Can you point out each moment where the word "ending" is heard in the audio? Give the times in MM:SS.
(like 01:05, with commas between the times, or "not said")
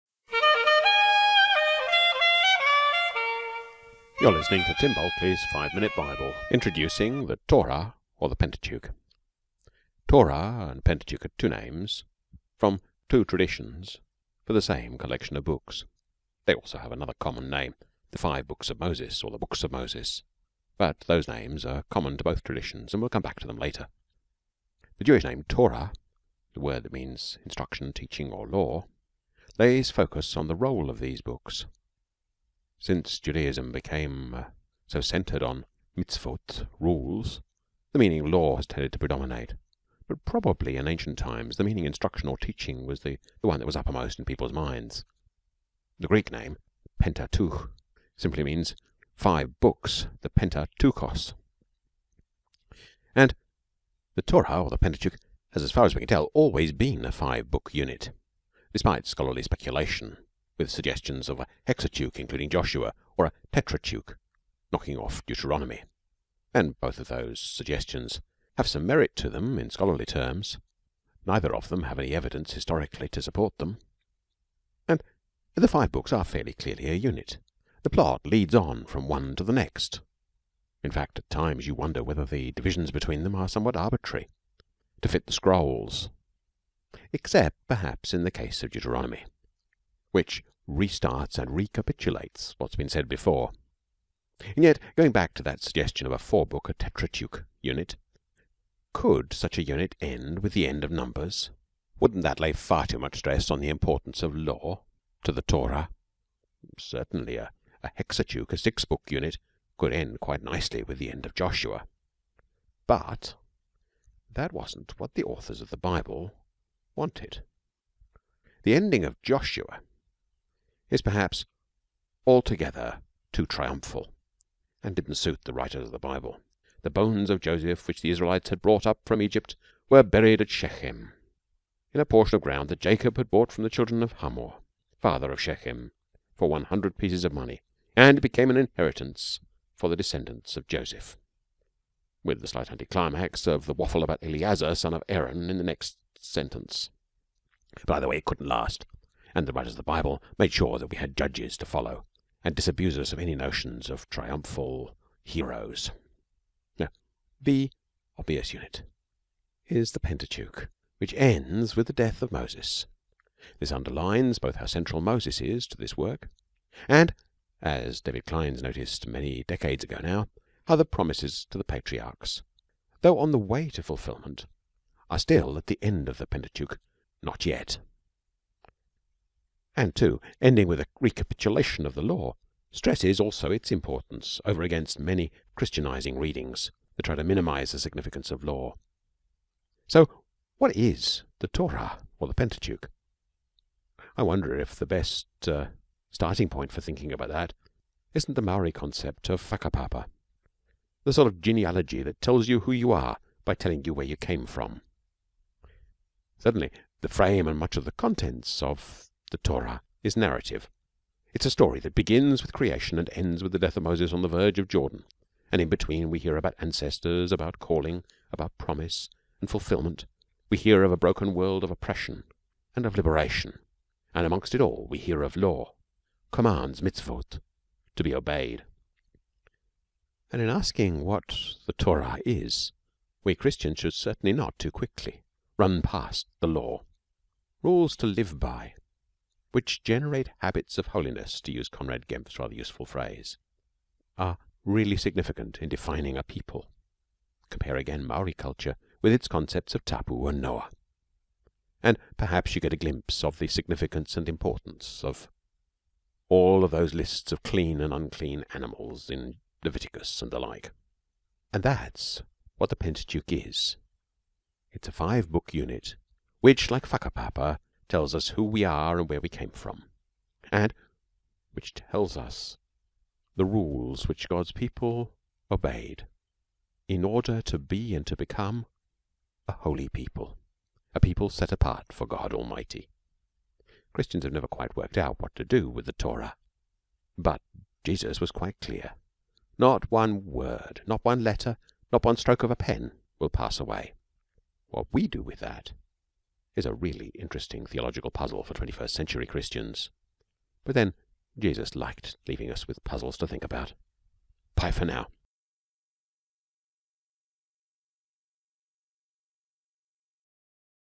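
01:58, 03:00.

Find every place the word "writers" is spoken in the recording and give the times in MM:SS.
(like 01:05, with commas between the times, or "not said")
02:05, 02:29.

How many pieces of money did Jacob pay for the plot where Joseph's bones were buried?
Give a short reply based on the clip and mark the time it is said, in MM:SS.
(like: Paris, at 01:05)
100, at 02:16.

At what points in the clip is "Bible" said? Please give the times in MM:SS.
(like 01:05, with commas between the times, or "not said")
00:05, 01:55, 02:05, 02:29.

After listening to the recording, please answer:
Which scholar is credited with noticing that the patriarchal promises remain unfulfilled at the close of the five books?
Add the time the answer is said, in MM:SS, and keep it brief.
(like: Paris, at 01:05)
David Clines, at 02:48.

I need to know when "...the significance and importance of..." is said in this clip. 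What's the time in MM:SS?
04:13.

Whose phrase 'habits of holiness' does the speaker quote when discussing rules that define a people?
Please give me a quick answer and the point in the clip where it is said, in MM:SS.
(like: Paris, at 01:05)
Conrad Gemp, at 04:01.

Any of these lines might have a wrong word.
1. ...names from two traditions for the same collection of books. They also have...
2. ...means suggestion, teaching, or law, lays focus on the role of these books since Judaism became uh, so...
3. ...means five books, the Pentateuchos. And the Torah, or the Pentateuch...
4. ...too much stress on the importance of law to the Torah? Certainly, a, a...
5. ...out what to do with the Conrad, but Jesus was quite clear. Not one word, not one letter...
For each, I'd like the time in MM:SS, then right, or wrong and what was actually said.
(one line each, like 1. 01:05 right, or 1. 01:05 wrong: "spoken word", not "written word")
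1. 00:11 right
2. 00:26 wrong: "instruction", not "suggestion"
3. 00:48 right
4. 01:42 right
5. 04:44 wrong: "Torah", not "Conrad".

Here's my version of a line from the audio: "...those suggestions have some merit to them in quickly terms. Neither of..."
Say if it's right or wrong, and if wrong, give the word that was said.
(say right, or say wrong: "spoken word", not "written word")
wrong: "scholarly", not "quickly".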